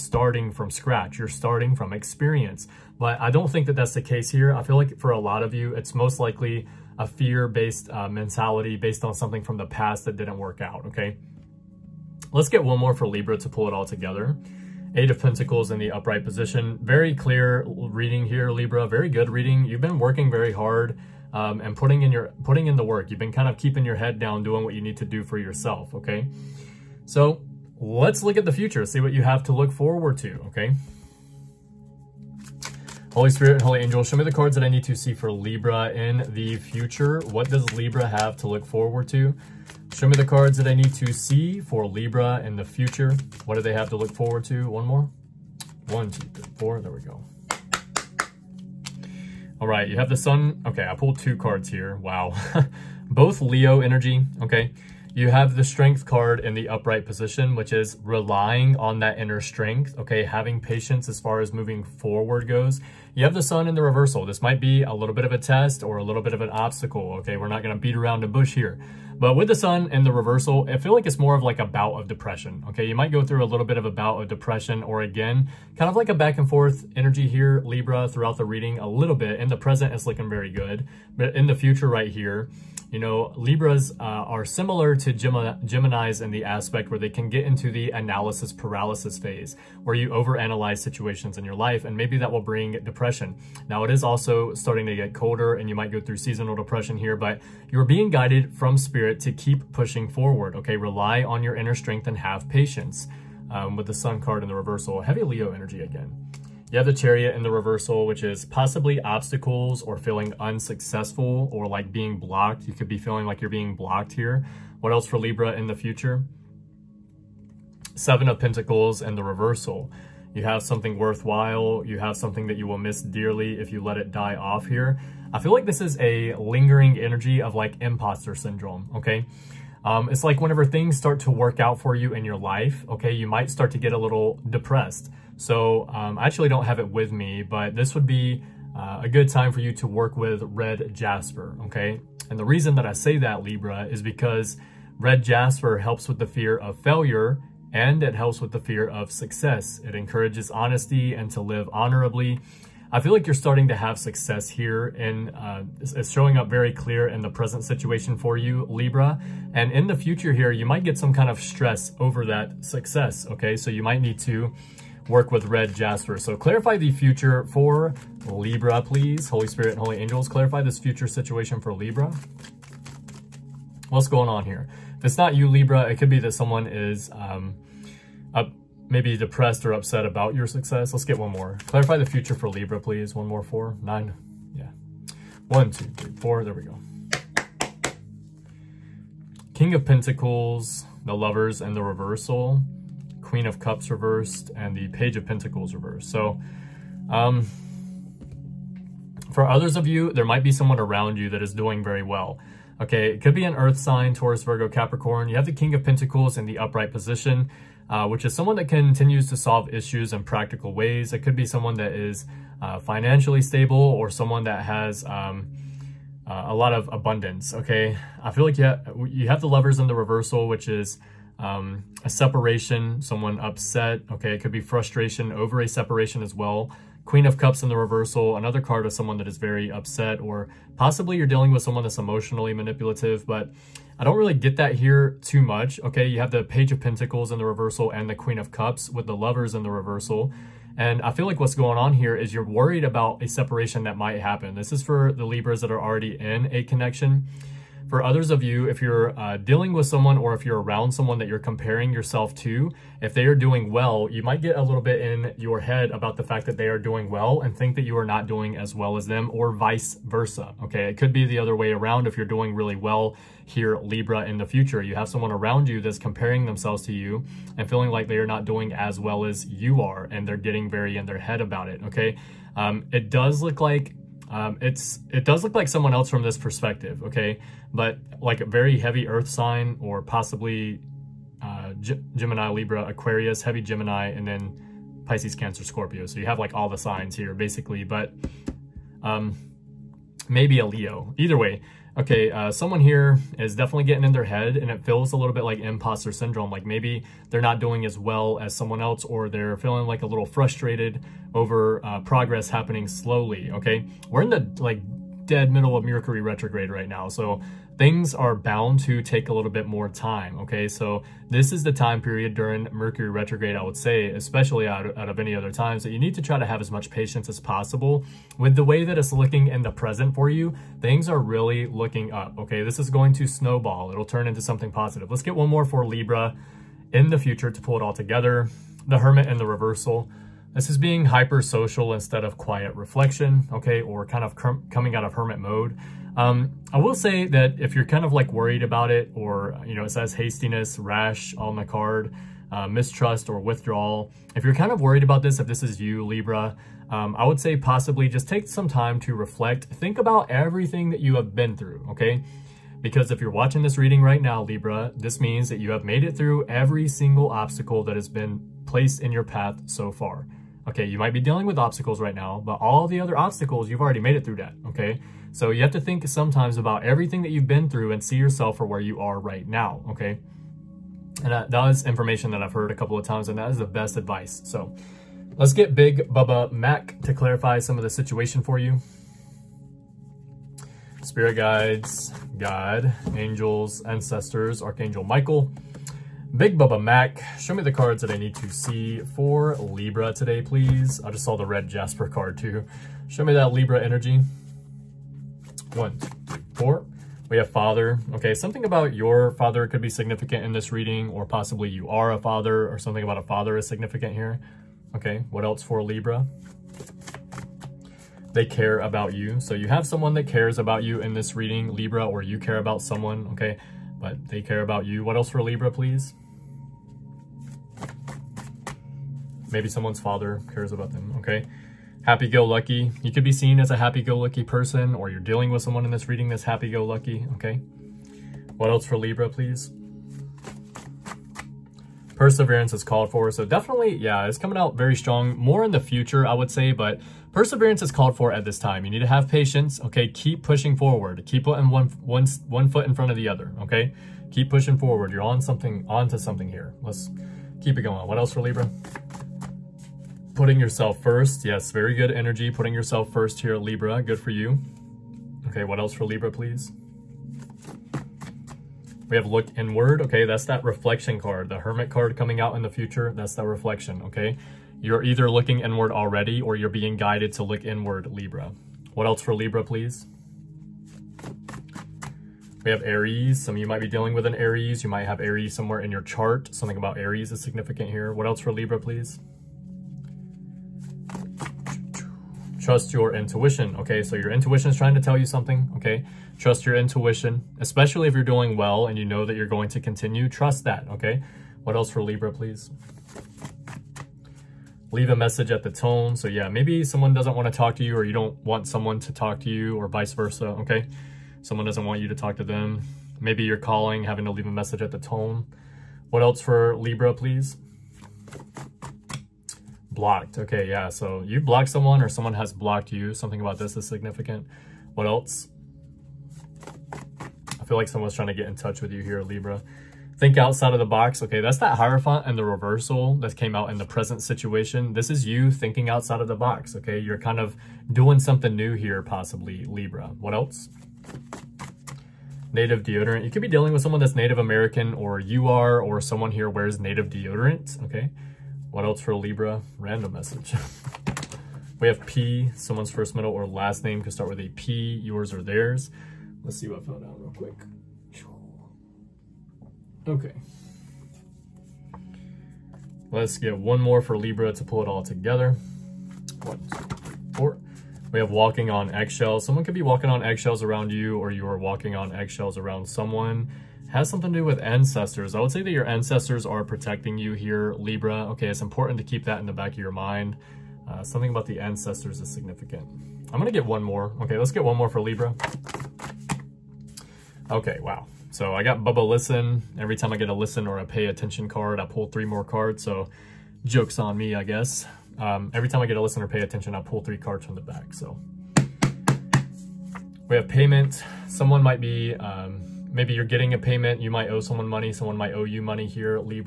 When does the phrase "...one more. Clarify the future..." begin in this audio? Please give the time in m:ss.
3:01.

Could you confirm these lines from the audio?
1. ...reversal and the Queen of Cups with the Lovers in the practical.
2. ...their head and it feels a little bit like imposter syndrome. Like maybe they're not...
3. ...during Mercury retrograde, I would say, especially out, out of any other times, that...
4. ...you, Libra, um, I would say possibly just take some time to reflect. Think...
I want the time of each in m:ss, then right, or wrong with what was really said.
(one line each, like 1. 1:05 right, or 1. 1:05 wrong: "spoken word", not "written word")
1. 3:57 wrong: "reversal", not "practical"
2. 4:54 right
3. 5:12 right
4. 5:45 right.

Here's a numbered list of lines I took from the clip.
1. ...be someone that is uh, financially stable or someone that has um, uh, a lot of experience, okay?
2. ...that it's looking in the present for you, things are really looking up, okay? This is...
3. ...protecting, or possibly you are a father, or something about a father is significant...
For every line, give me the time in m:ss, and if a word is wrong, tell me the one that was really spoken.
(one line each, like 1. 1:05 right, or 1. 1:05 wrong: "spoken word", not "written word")
1. 3:31 wrong: "abundance", not "experience"
2. 5:18 right
3. 6:40 wrong: "reading", not "protecting".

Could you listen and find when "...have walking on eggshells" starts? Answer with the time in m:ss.
9:18.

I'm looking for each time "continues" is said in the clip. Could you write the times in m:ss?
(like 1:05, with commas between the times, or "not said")
3:28, 8:09.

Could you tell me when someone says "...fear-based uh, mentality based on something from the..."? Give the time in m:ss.
0:07.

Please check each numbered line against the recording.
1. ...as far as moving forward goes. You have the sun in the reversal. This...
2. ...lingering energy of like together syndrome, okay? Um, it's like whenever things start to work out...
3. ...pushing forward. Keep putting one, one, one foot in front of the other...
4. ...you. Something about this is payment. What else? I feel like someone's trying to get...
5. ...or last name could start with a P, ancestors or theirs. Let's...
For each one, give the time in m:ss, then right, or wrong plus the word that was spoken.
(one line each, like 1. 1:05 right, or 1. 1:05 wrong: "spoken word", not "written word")
1. 1:01 right
2. 2:06 wrong: "imposter", not "together"
3. 7:20 right
4. 8:32 wrong: "significant", not "payment"
5. 9:03 wrong: "yours", not "ancestors".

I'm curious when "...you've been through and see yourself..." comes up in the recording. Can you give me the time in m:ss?
6:07.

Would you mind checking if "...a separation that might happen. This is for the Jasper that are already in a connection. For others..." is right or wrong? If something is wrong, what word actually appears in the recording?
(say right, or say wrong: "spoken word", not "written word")
wrong: "Libras", not "Jasper".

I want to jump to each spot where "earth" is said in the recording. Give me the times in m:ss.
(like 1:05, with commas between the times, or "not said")
3:23, 4:39.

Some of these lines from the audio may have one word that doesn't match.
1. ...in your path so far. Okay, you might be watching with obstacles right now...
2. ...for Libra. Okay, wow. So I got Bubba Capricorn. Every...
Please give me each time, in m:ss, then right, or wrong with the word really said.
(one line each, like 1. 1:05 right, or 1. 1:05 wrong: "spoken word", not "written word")
1. 5:59 wrong: "dealing", not "watching"
2. 9:34 wrong: "Listen", not "Capricorn".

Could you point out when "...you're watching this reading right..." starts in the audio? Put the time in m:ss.
5:53.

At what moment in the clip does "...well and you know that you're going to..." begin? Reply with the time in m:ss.
8:08.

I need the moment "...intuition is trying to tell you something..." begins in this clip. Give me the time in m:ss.
8:04.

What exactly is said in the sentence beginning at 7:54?
You might have Aries somewhere in your chart.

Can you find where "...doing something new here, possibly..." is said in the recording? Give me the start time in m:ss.
8:47.